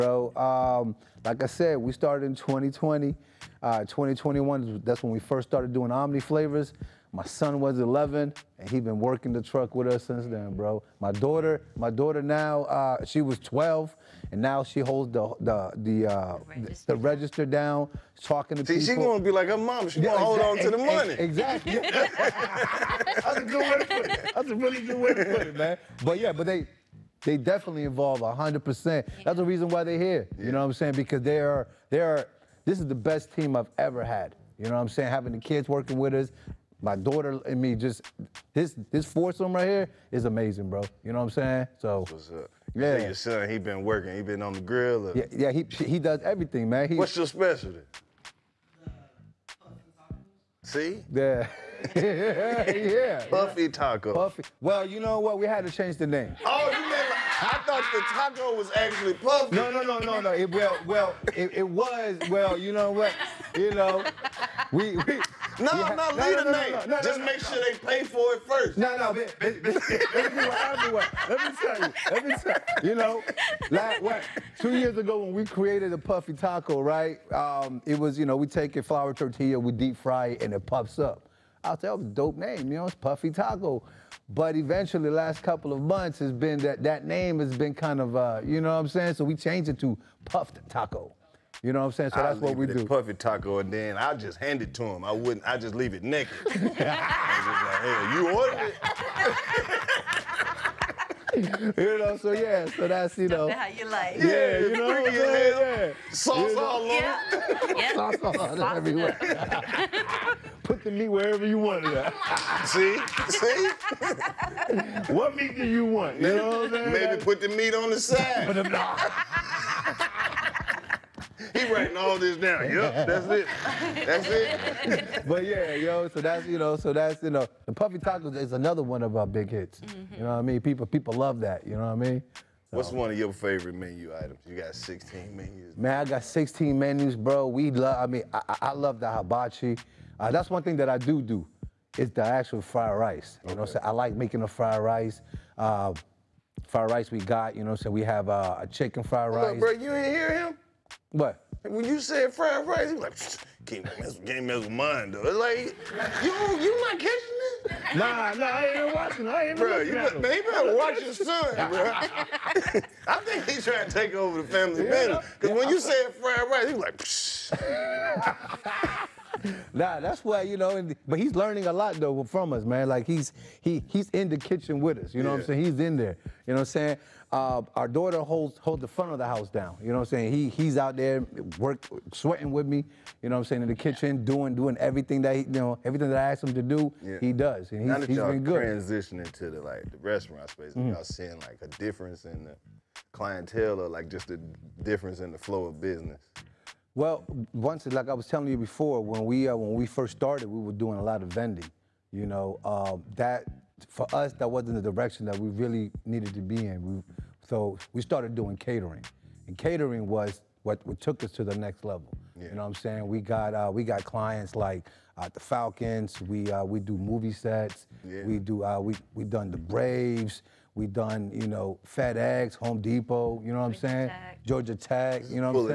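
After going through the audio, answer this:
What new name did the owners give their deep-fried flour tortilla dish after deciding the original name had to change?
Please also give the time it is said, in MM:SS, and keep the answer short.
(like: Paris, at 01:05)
Puffed Taco, at 01:30.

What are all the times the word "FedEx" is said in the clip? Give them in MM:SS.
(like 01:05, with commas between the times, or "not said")
03:41.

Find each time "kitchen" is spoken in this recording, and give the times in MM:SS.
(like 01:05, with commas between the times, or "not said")
02:54, 03:03.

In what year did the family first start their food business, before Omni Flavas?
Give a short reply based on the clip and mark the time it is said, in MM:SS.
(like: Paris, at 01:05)
2020, at 00:02.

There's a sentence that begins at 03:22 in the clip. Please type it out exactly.
You know uh, that for us that wasn't the direction that we really needed to be in.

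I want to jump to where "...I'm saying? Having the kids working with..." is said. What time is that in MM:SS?
00:34.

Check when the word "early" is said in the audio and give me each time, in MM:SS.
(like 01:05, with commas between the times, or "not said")
not said.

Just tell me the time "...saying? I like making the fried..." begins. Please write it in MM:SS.
02:23.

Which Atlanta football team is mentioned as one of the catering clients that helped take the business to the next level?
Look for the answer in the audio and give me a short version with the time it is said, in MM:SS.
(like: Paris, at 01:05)
The Falcons, at 03:35.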